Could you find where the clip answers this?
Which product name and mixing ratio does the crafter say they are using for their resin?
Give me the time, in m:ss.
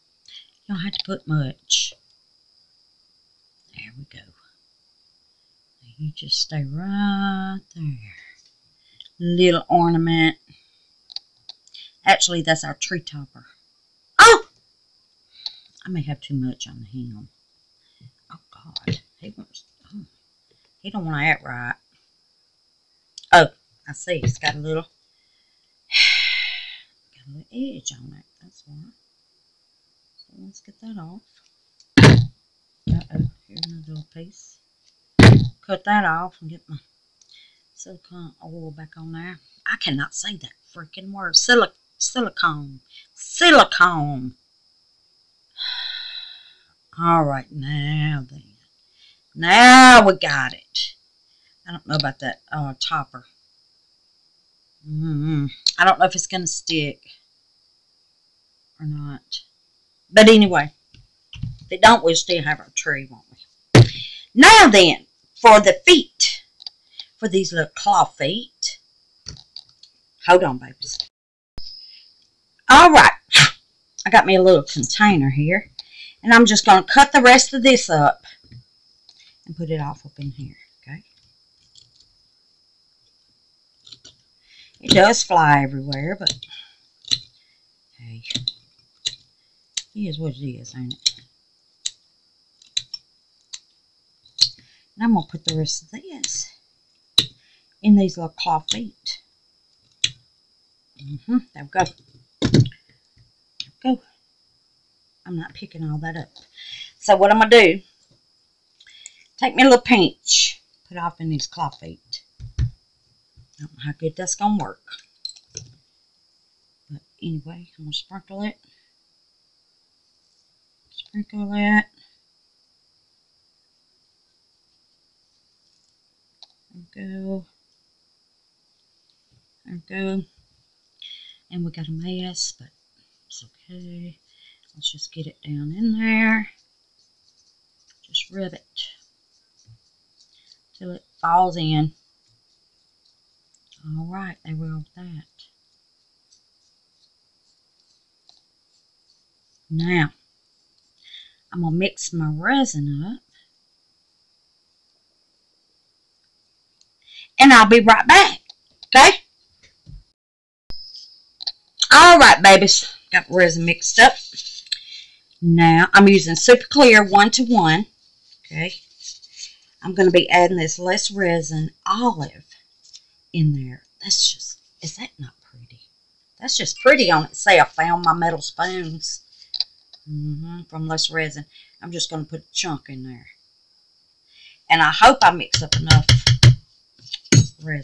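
2:46.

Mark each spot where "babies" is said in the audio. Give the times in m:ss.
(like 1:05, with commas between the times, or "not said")
1:10, 2:42.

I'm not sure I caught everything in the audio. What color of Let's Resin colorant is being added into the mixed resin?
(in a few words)
Olive.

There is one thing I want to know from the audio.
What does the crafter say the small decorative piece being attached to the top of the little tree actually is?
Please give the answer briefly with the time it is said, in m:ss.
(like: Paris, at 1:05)
Tree topper, at 0:12.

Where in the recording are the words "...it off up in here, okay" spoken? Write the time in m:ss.
1:19.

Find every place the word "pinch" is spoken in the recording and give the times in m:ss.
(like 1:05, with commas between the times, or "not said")
1:49.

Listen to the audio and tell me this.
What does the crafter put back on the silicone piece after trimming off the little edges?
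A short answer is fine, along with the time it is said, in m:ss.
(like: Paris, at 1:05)
Silicone oil, at 0:37.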